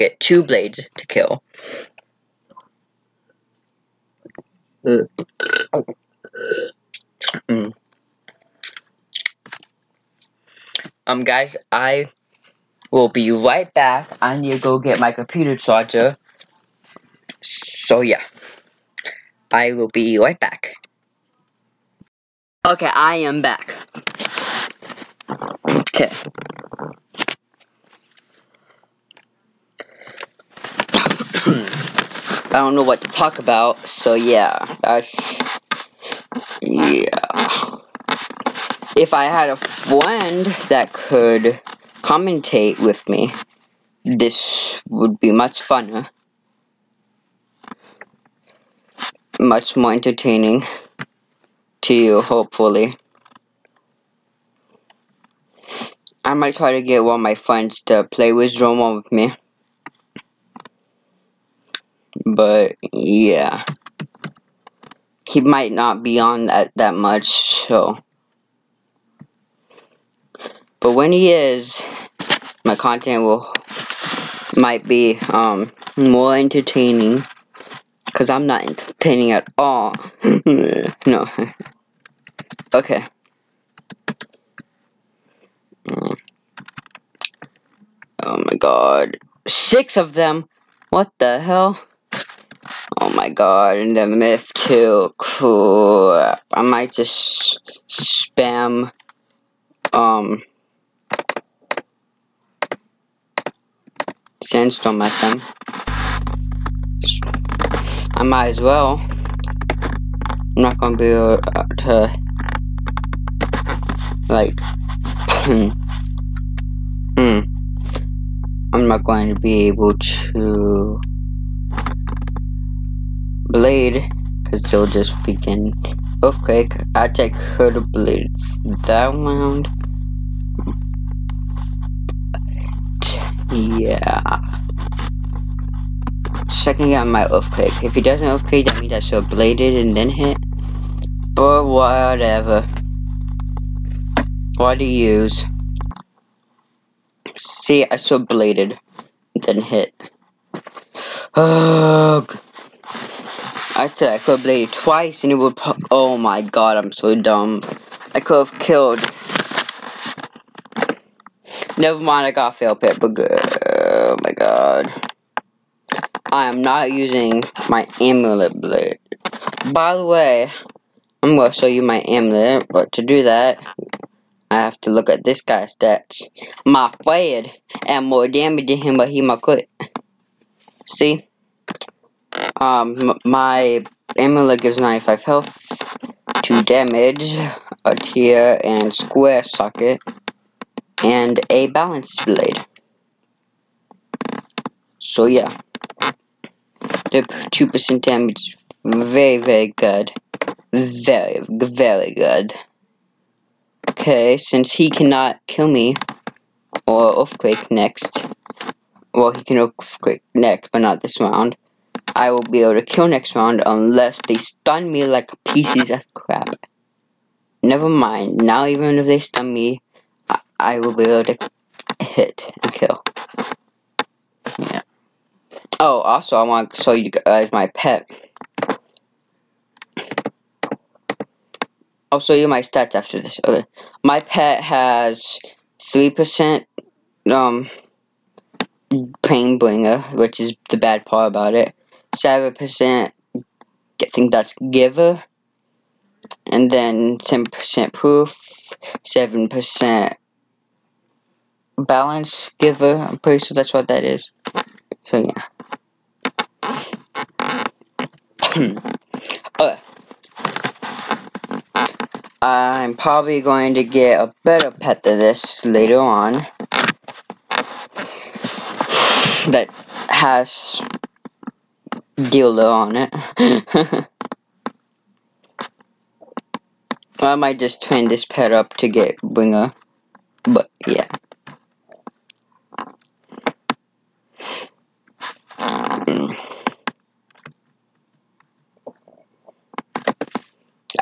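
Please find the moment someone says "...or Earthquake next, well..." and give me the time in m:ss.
3:26.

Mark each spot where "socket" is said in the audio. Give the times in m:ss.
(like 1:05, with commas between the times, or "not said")
3:09.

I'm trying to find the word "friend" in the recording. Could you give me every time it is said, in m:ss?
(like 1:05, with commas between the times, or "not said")
0:39, 0:57, 2:57.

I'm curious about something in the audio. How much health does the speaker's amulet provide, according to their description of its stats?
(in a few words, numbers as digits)
95.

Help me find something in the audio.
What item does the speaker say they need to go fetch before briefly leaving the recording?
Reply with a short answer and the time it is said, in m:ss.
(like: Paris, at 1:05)
Computer charger, at 0:15.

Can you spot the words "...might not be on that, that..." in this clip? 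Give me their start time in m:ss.
1:05.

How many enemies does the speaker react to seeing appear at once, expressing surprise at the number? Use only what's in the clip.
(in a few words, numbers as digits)
6.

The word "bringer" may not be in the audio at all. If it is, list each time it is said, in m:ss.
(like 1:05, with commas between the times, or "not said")
3:59.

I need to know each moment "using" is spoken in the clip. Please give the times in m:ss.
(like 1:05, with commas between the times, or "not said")
2:46.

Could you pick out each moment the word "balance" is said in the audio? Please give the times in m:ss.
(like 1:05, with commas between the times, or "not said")
3:11, 4:11.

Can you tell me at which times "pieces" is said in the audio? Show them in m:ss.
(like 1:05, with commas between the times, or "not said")
3:35.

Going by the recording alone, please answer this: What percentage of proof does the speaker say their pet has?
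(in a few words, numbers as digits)
10%.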